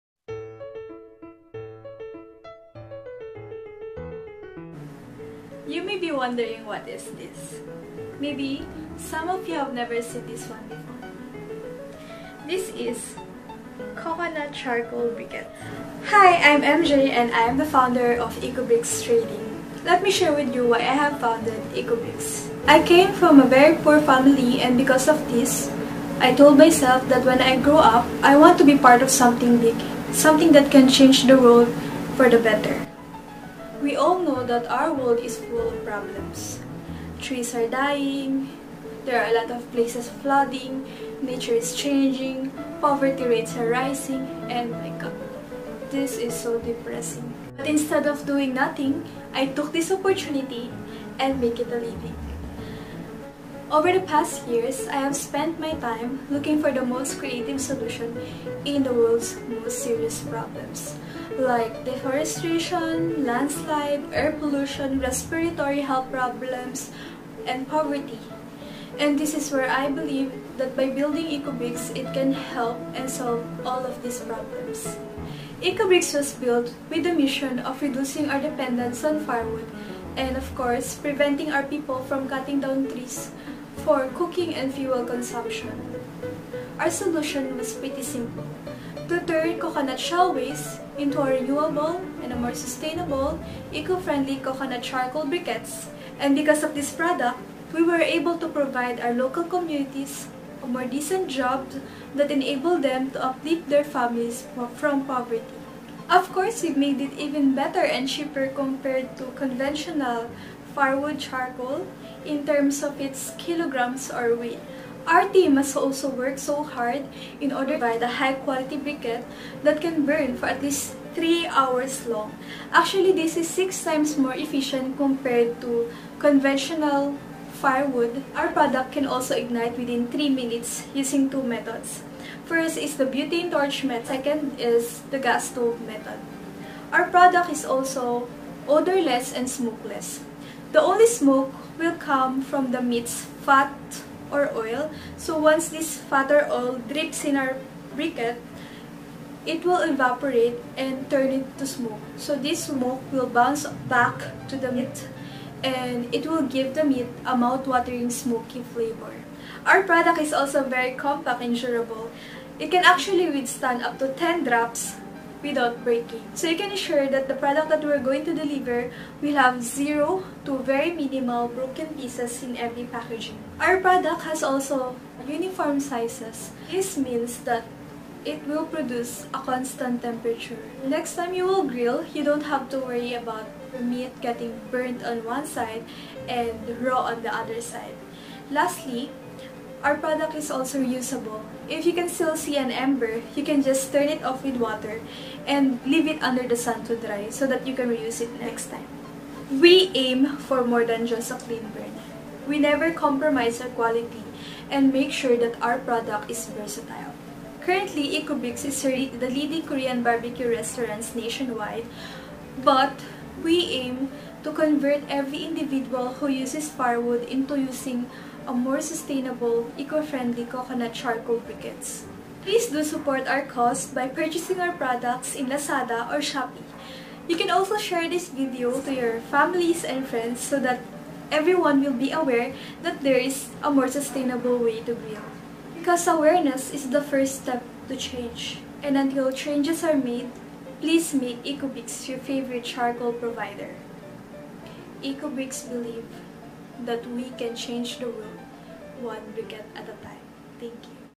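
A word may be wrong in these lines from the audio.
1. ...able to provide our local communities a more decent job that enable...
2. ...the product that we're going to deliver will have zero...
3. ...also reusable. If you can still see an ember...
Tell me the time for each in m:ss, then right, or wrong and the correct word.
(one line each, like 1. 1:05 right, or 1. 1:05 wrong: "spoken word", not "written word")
1. 1:37 right
2. 2:47 right
3. 3:10 right.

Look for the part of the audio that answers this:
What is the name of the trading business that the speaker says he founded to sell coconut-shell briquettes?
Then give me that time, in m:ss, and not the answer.
0:18.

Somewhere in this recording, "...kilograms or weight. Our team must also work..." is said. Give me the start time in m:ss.
1:53.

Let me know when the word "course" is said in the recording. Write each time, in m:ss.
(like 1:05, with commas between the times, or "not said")
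1:20, 1:46.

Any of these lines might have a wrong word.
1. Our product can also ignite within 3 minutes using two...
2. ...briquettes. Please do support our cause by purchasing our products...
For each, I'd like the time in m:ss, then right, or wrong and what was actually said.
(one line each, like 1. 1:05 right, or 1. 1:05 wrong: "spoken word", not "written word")
1. 2:08 right
2. 3:41 right.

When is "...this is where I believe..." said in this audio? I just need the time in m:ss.
1:09.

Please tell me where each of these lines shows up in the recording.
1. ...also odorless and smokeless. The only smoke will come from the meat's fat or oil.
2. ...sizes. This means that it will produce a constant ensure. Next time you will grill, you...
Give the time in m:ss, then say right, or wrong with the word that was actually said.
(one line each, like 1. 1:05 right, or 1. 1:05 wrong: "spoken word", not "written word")
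1. 2:17 right
2. 2:55 wrong: "temperature", not "ensure".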